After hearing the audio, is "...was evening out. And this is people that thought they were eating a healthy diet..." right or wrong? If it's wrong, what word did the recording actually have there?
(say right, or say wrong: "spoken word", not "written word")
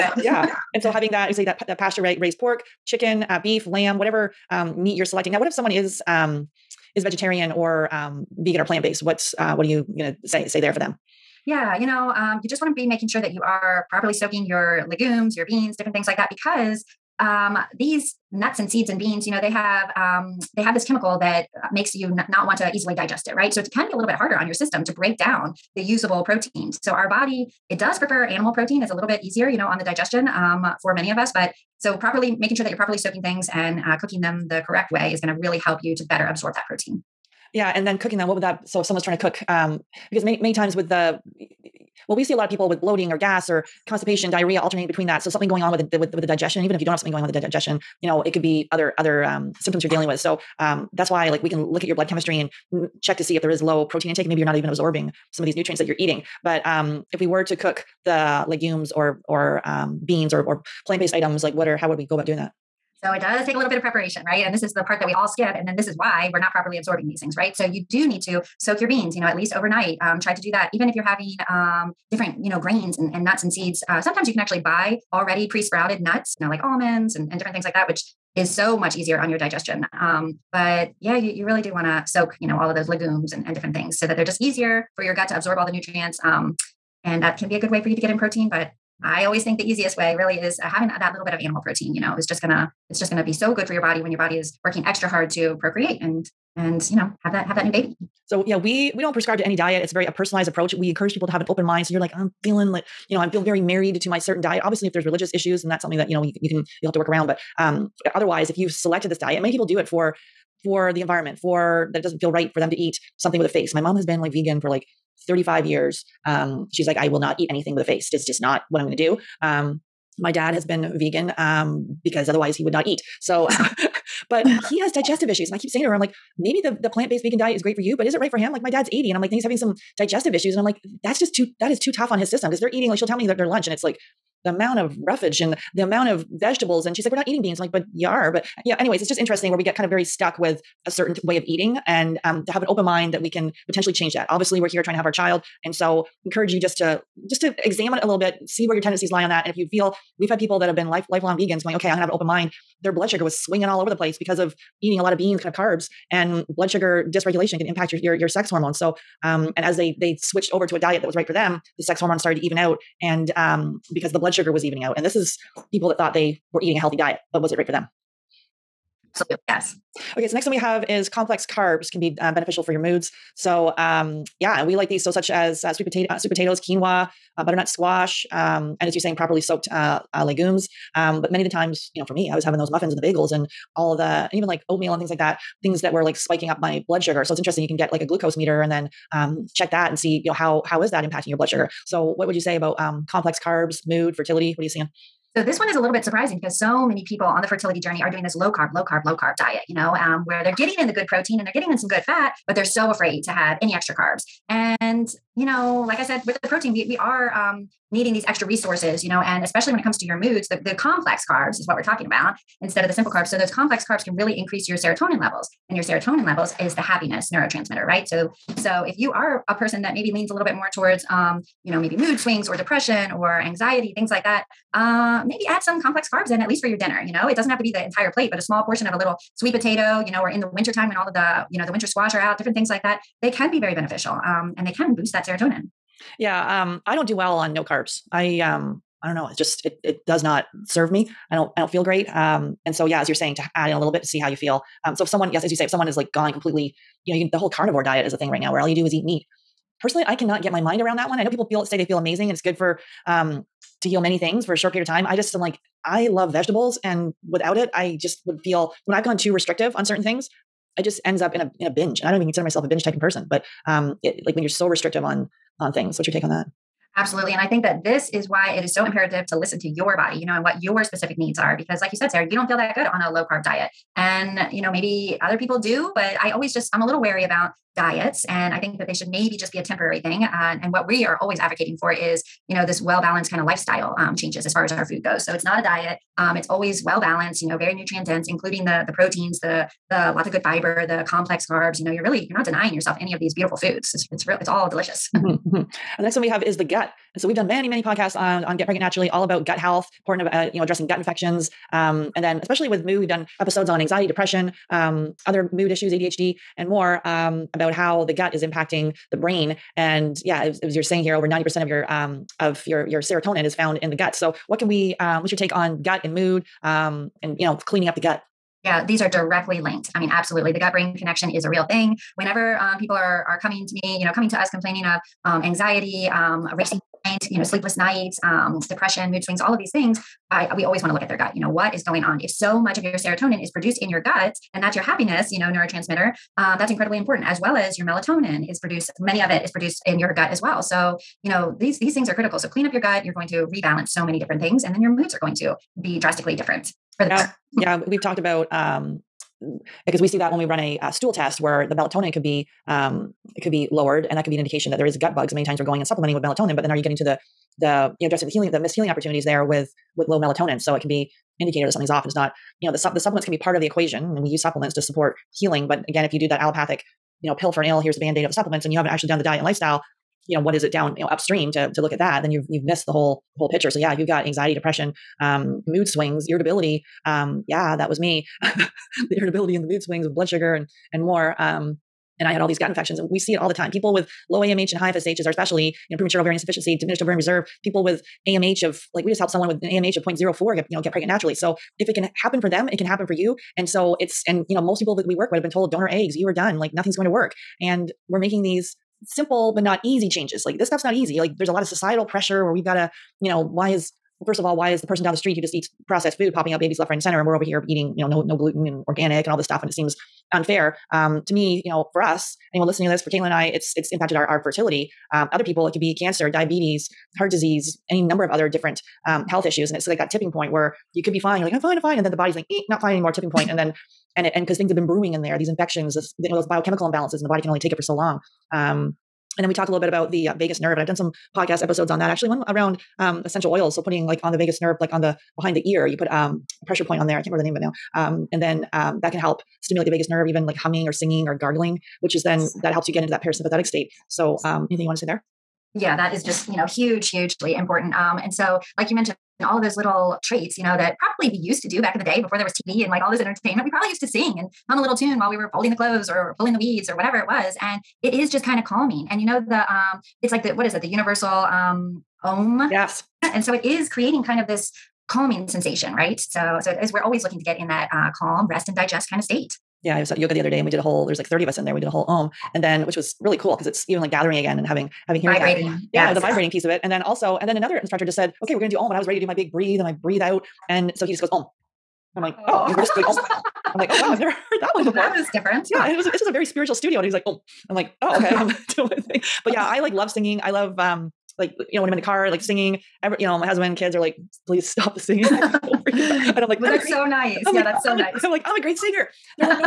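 right.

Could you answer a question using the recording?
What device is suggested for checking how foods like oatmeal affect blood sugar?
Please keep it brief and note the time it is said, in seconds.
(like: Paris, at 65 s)
Glucose meter, at 188 s.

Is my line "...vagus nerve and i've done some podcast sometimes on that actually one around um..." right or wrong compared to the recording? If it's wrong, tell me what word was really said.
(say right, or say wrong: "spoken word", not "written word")
wrong: "episodes", not "sometimes".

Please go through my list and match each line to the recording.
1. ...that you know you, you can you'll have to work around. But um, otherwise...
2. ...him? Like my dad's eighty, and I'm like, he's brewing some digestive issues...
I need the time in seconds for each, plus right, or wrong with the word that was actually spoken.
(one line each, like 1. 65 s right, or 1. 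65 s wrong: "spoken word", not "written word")
1. 105 s right
2. 128 s wrong: "having", not "brewing".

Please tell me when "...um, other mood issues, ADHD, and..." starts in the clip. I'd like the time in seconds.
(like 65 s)
304 s.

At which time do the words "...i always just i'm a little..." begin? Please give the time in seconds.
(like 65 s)
276 s.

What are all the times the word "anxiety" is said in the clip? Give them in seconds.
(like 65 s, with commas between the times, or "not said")
223 s, 303 s, 325 s, 374 s.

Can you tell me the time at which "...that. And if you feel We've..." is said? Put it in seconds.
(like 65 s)
149 s.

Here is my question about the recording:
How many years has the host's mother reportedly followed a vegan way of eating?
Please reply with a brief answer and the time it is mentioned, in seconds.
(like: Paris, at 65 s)
35 years, at 115 s.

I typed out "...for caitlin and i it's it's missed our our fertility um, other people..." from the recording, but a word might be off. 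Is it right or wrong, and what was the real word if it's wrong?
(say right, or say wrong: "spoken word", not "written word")
wrong: "impacted", not "missed".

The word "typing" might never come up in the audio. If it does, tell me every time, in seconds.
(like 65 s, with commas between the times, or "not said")
262 s.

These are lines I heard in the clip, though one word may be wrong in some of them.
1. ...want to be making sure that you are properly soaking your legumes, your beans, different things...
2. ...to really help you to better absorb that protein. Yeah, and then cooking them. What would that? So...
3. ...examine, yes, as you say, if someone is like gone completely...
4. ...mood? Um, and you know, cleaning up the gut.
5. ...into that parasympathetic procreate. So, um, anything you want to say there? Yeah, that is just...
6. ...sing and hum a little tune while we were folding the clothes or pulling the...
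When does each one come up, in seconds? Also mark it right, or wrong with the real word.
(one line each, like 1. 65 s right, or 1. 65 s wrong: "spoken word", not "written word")
1. 12 s right
2. 35 s right
3. 245 s wrong: "someone", not "examine"
4. 316 s right
5. 443 s wrong: "state", not "procreate"
6. 454 s right.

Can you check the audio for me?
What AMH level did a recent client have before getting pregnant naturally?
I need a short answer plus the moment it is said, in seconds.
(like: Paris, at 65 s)
0.04, at 390 s.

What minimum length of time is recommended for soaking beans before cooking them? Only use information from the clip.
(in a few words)
Overnight.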